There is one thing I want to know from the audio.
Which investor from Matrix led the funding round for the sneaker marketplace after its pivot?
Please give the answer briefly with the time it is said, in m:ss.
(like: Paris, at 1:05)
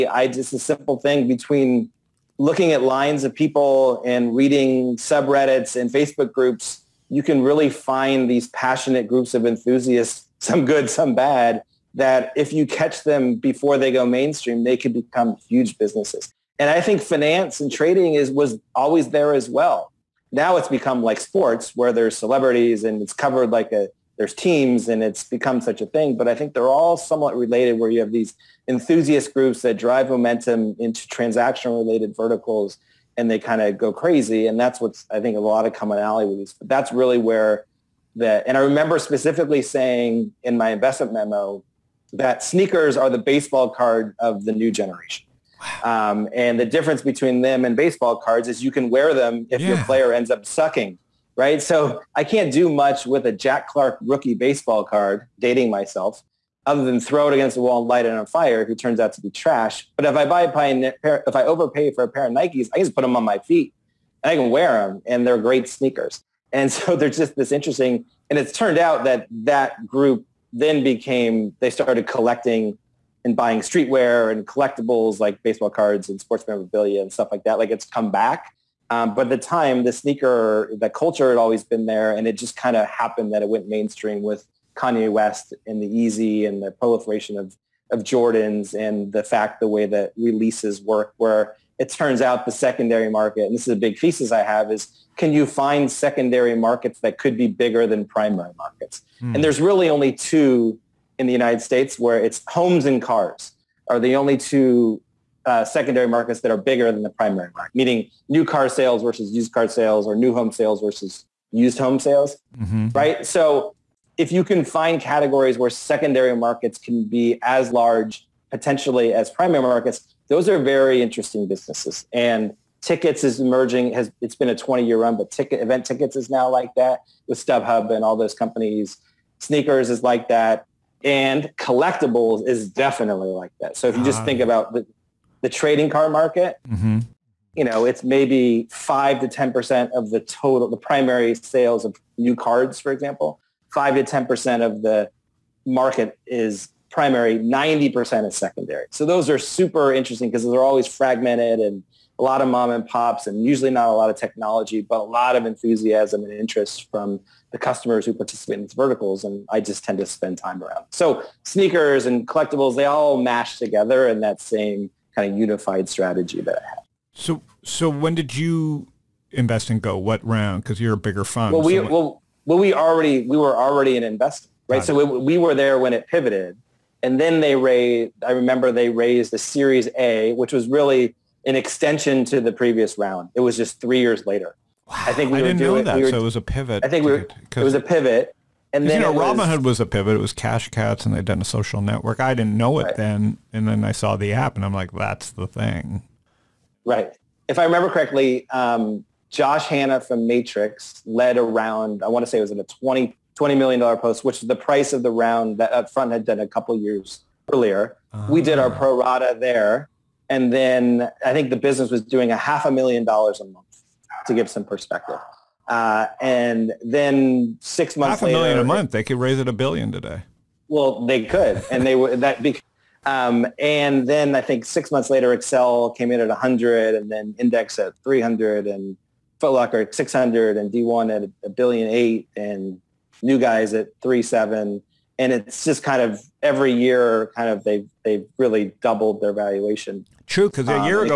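Josh Hannah, at 3:19.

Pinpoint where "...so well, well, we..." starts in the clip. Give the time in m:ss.
2:51.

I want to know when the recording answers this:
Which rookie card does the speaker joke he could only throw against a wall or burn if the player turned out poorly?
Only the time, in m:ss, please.
0:53.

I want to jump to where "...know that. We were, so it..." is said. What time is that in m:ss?
3:05.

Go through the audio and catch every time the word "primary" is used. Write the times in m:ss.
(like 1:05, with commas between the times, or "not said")
1:38, 1:47, 1:59, 2:20, 2:26.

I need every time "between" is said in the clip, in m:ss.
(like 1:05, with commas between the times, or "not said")
0:01, 0:47.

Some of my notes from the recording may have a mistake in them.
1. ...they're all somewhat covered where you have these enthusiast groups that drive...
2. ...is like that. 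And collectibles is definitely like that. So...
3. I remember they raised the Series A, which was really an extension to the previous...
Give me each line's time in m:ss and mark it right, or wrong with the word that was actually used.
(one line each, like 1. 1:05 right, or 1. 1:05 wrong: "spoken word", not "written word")
1. 0:26 wrong: "related", not "covered"
2. 2:09 right
3. 2:58 right.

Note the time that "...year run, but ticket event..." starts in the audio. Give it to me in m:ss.
2:04.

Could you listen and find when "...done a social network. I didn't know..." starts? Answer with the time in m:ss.
3:11.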